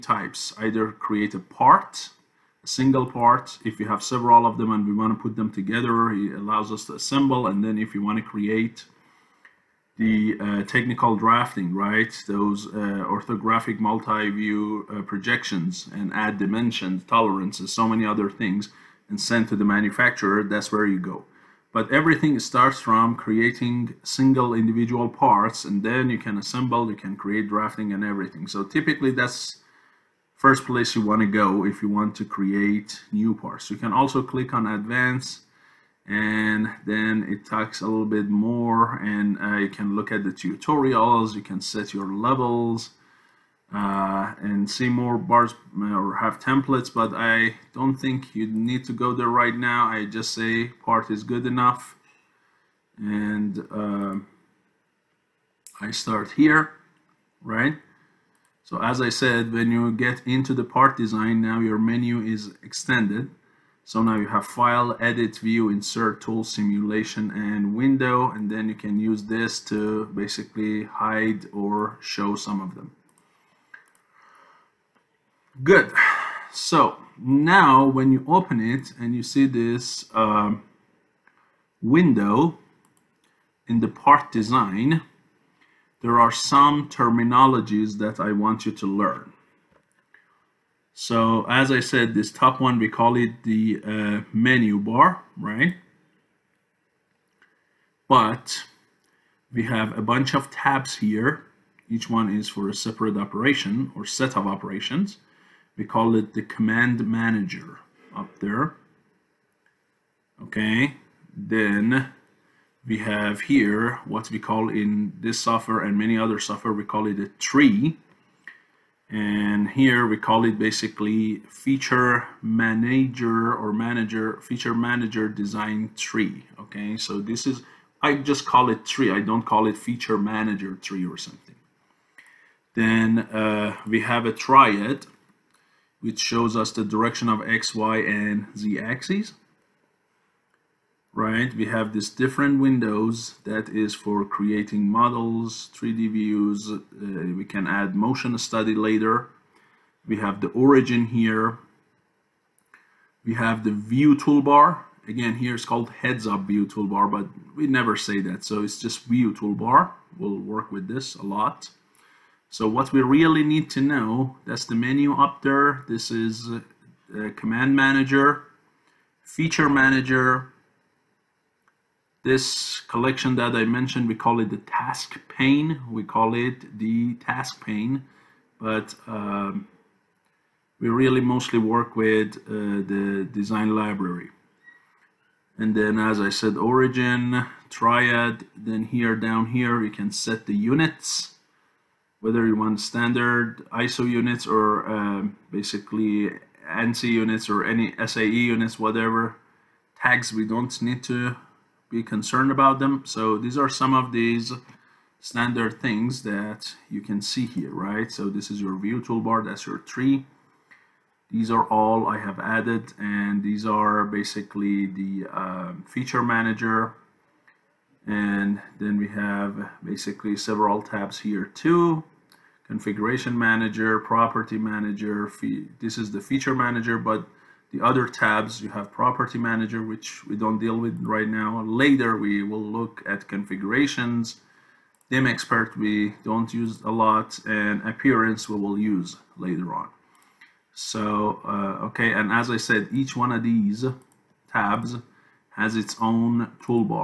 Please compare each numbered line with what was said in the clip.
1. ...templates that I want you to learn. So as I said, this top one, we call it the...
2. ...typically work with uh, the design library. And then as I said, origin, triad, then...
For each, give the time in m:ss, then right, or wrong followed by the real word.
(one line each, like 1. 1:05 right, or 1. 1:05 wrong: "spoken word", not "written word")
1. 1:26 wrong: "terminologies", not "templates"
2. 3:01 wrong: "mostly", not "typically".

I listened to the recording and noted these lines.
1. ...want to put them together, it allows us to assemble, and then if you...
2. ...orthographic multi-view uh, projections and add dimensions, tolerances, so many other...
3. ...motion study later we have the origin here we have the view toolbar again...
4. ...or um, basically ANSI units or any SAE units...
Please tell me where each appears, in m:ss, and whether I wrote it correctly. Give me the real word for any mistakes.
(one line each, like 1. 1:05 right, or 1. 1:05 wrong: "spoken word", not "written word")
1. 0:04 right
2. 0:13 right
3. 2:27 right
4. 3:14 right.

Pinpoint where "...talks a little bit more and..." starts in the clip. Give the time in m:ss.
0:37.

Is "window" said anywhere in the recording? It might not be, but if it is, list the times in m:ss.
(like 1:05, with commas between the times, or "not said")
1:07, 1:21, 2:22.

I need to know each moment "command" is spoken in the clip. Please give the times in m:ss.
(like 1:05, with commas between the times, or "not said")
1:46, 2:47.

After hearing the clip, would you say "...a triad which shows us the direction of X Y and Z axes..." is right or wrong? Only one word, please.
right.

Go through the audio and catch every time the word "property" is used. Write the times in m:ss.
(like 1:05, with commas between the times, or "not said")
3:43, 3:48.